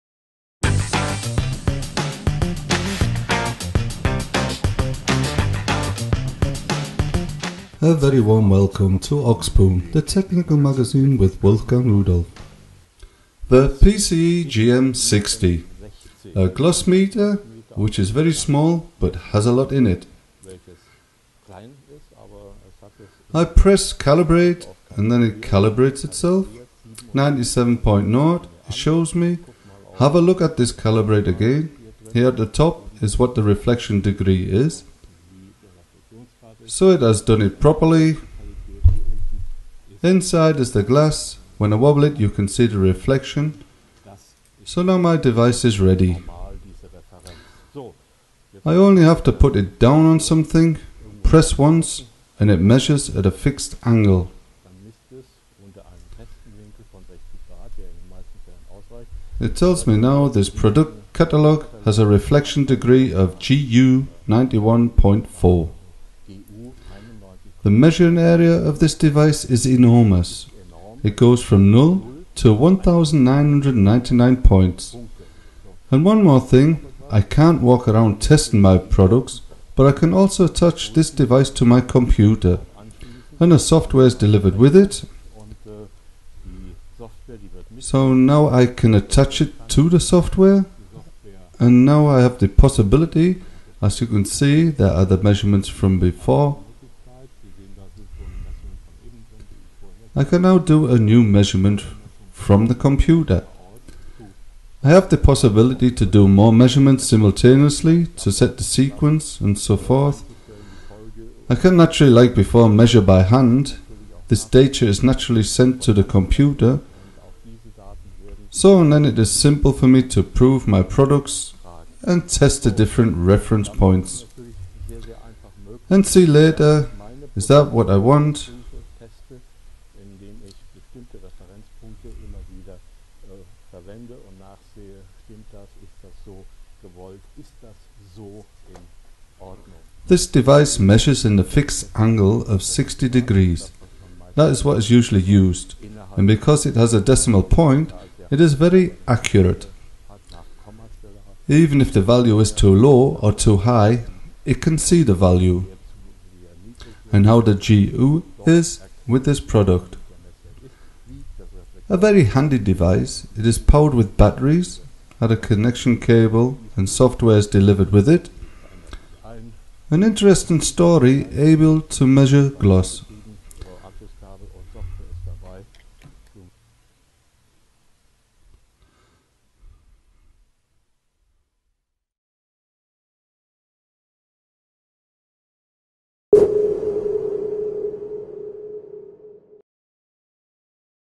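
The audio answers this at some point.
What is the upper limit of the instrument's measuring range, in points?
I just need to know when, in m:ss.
1:12.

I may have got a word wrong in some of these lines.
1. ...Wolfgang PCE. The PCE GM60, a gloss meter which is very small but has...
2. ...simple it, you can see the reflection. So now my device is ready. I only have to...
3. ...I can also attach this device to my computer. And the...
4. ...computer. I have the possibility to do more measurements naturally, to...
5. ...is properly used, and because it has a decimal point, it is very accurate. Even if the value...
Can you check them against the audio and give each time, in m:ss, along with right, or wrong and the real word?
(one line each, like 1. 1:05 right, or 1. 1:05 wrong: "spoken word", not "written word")
1. 0:11 wrong: "Rudolph", not "PCE"
2. 0:41 wrong: "wobble", not "simple"
3. 1:19 right
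4. 1:42 wrong: "simultaneously", not "naturally"
5. 2:24 wrong: "usually", not "properly".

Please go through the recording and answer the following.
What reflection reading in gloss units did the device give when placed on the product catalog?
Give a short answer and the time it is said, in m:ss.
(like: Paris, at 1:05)
91.4, at 1:04.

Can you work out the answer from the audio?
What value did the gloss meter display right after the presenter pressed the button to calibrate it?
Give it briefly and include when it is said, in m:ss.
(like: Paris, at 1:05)
97.0, at 0:27.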